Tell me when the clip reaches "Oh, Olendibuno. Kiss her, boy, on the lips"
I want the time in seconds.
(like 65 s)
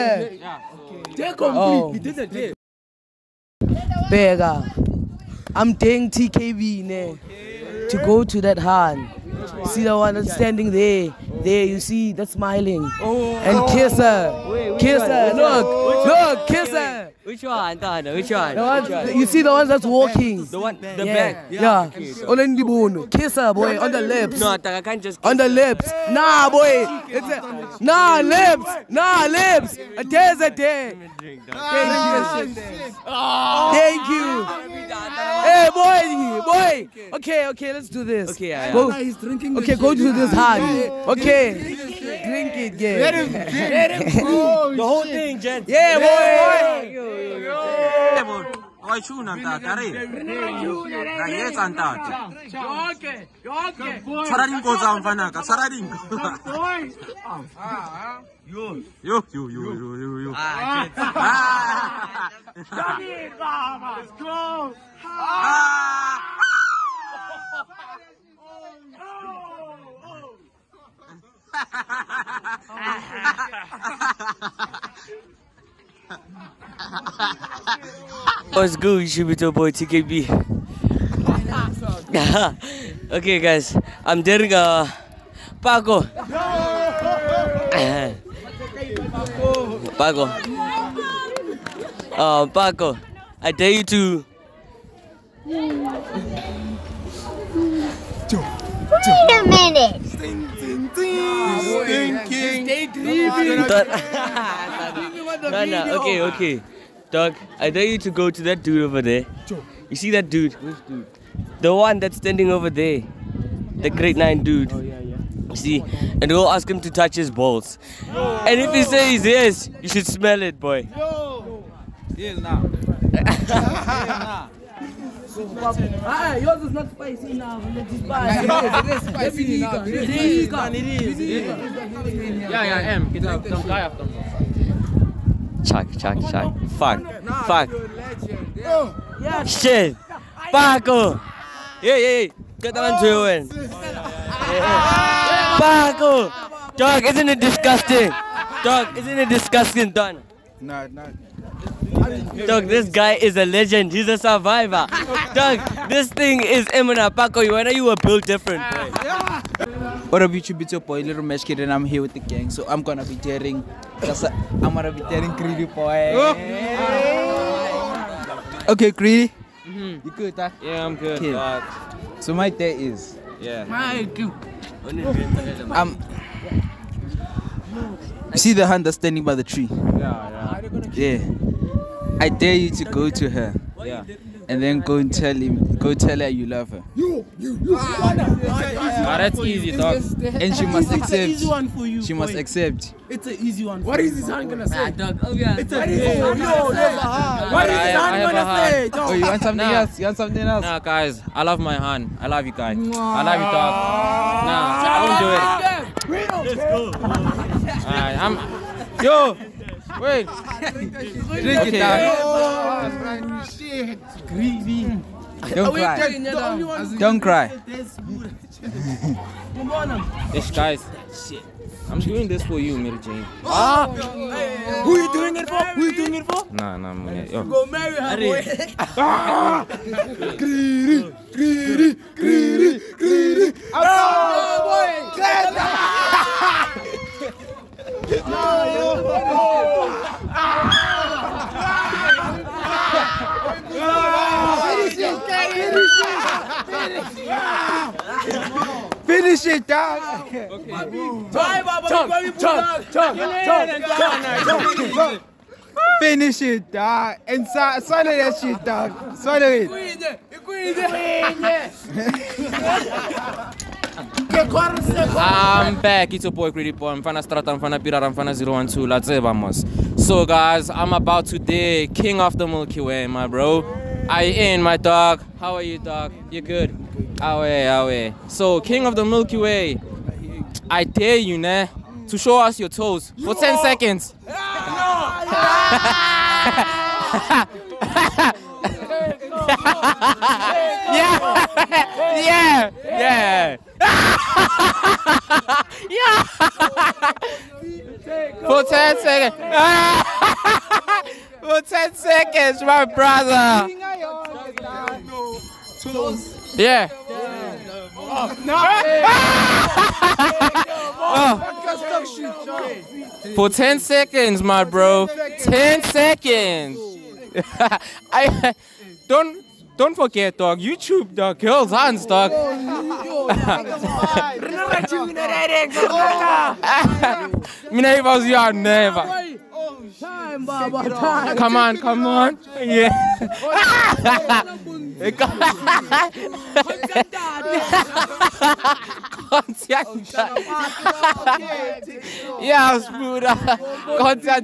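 22 s.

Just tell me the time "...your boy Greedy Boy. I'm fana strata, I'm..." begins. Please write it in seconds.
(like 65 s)
266 s.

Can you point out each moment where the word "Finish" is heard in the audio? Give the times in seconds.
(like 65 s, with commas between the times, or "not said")
256 s.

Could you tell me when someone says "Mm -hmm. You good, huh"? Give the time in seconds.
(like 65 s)
169 s.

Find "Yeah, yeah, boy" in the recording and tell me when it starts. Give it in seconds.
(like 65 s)
45 s.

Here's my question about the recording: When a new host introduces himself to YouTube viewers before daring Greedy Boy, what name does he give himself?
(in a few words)
Little Mesh Kid.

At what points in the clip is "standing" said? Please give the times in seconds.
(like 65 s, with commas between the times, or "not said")
10 s, 112 s, 178 s.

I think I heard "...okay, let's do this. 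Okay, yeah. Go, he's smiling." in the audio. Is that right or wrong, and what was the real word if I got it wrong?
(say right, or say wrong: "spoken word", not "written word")
wrong: "drinking", not "smiling".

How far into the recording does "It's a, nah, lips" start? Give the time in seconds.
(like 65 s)
27 s.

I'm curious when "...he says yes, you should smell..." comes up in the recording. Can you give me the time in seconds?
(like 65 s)
118 s.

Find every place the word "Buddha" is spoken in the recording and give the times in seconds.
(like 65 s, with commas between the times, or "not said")
342 s.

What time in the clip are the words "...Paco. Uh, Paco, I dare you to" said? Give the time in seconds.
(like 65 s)
90 s.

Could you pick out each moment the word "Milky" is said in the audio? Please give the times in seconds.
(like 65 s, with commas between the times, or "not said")
272 s, 279 s.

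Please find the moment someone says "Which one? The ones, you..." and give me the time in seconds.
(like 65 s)
18 s.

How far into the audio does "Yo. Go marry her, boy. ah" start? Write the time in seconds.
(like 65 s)
227 s.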